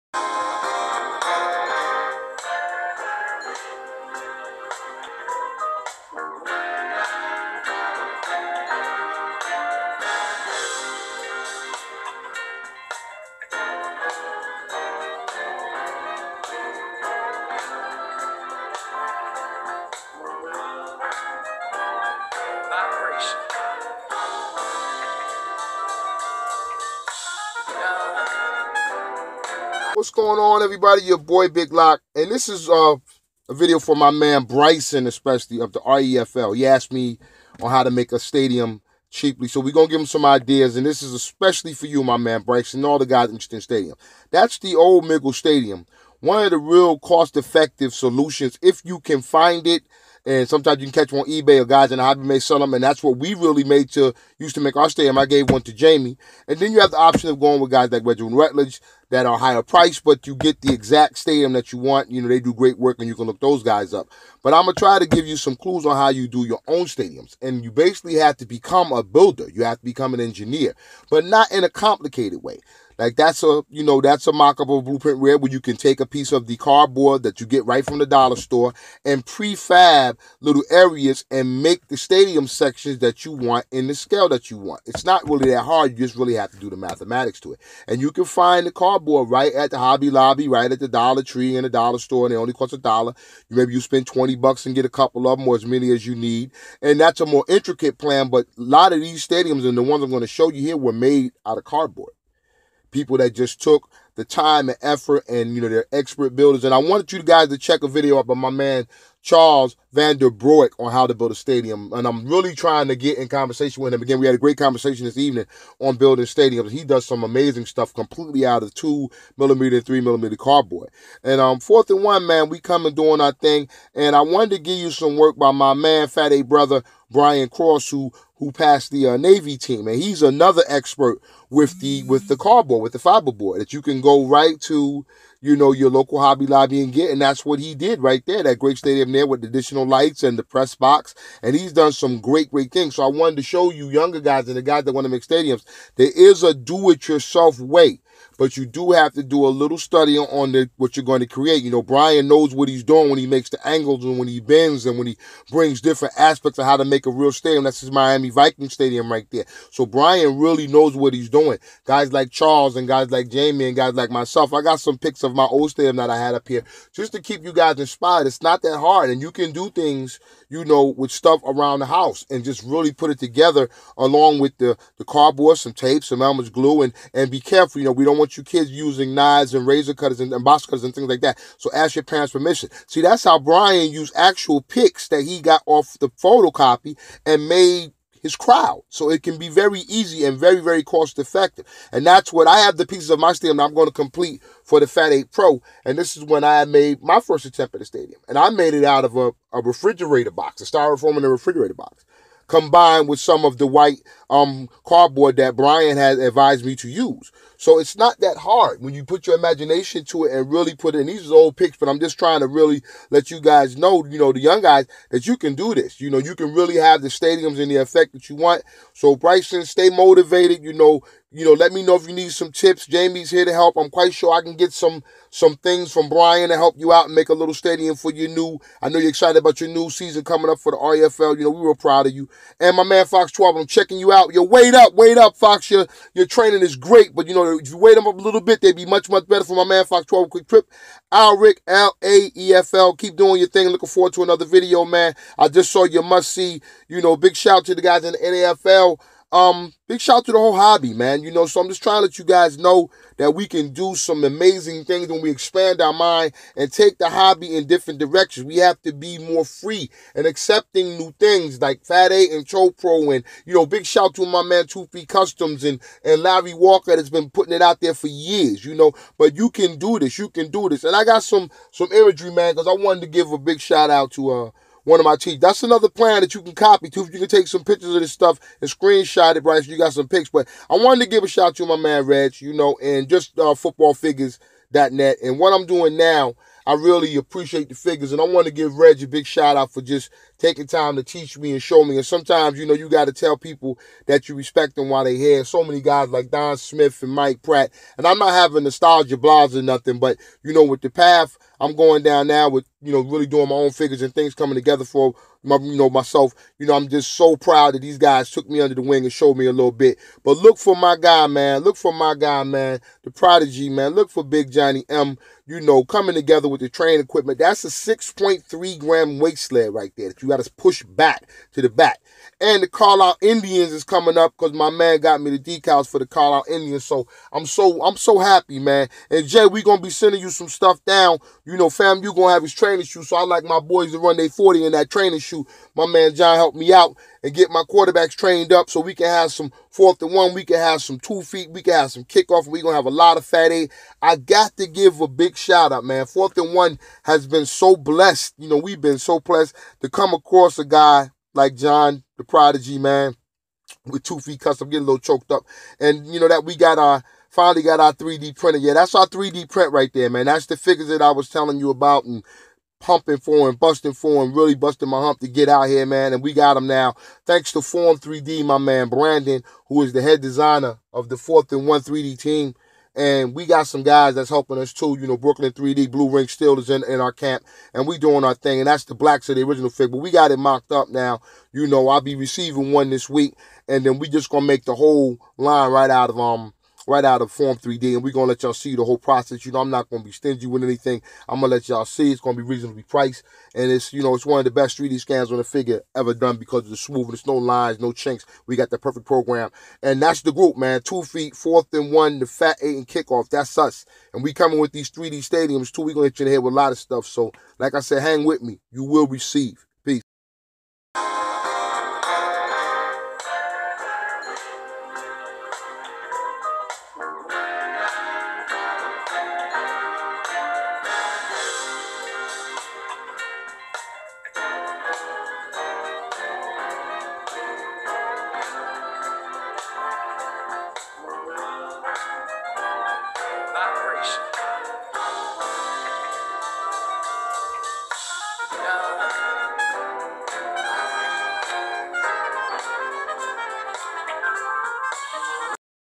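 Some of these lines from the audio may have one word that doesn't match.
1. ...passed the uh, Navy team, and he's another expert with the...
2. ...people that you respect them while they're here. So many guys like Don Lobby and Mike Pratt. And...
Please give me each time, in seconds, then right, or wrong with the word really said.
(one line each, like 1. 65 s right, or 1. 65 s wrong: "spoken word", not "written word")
1. 128 s right
2. 293 s wrong: "Smith", not "Lobby".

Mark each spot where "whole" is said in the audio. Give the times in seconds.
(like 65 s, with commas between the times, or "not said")
250 s, 384 s, 388 s.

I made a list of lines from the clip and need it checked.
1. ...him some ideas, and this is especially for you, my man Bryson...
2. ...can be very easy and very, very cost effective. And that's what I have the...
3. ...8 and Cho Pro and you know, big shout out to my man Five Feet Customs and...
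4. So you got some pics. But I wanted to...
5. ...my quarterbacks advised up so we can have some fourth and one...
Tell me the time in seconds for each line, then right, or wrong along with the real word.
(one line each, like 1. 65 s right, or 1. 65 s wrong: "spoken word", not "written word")
1. 39 s right
2. 189 s right
3. 262 s wrong: "Two", not "Five"
4. 279 s right
5. 337 s wrong: "trained", not "advised".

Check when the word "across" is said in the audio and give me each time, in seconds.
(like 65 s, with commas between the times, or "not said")
350 s.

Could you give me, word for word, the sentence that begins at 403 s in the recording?
That's us, and we coming with these 3D stadiums, too.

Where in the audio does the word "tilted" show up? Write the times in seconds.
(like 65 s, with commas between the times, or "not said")
not said.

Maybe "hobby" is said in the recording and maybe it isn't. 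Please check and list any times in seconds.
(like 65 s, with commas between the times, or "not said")
52 s, 89 s, 136 s, 250 s, 257 s.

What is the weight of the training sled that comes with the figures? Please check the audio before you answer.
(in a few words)
6.3 grams.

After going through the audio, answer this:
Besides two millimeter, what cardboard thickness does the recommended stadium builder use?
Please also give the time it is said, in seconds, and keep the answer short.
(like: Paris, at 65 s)
3 millimeter, at 119 s.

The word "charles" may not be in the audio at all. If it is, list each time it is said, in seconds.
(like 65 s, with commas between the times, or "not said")
109 s, 162 s.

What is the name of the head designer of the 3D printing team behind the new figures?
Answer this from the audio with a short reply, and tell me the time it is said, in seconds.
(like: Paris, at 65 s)
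Brandon, at 368 s.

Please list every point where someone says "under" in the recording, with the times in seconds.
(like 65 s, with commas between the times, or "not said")
308 s.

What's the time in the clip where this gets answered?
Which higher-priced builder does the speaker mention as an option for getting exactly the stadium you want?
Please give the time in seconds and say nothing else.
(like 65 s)
58 s.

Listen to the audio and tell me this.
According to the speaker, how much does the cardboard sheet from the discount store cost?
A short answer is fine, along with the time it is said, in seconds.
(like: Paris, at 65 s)
a dollar, at 92 s.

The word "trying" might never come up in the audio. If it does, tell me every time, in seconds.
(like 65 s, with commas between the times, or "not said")
112 s, 212 s, 251 s.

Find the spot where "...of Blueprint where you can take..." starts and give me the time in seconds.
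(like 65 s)
74 s.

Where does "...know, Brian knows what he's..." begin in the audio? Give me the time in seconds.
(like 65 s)
151 s.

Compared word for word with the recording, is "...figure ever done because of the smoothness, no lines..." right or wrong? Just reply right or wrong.
right.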